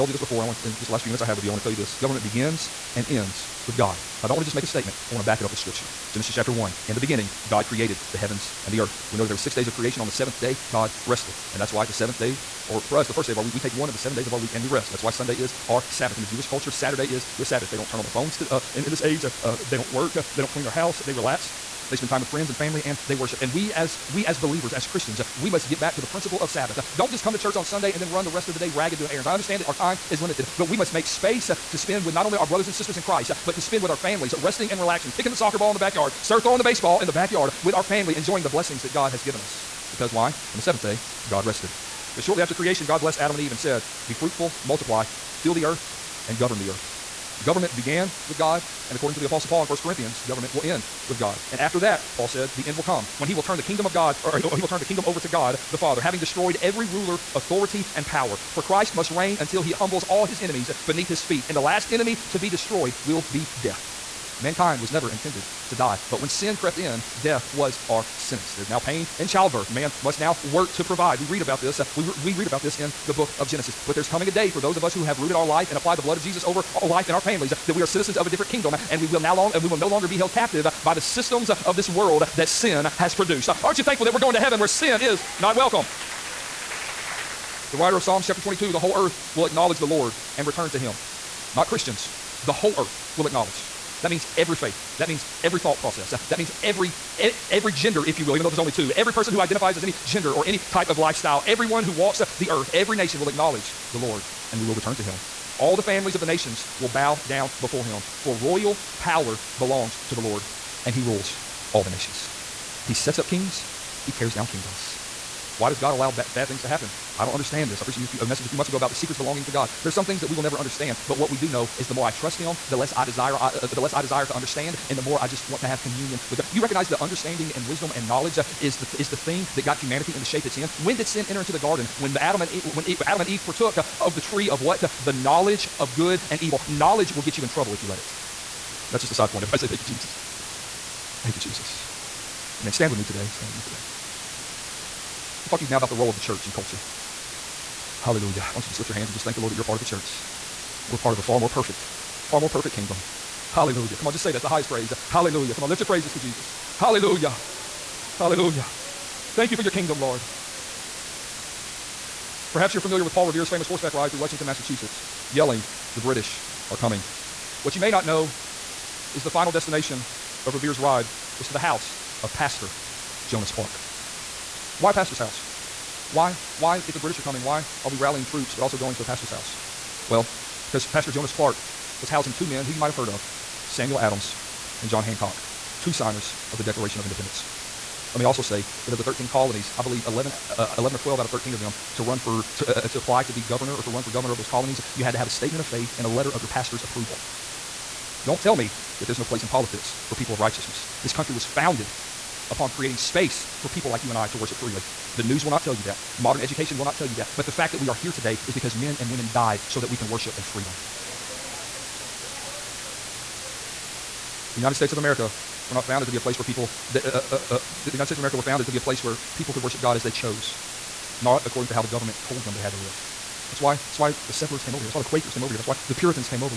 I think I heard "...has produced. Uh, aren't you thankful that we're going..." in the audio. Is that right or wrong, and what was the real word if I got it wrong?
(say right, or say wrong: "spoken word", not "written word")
right.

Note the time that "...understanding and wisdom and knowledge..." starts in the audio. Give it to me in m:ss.
2:07.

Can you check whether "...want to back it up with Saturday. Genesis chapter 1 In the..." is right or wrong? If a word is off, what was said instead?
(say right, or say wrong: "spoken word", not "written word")
wrong: "Scripture", not "Saturday".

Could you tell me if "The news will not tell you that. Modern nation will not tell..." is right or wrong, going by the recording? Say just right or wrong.
wrong.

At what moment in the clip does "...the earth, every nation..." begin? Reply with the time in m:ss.
1:42.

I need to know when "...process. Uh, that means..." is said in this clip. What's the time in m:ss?
1:35.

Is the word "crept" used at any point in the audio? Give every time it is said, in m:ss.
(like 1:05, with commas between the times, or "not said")
1:06.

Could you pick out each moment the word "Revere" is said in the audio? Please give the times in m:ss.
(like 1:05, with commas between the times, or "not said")
2:43, 2:50.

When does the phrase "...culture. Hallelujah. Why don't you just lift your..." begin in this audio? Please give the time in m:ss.
2:26.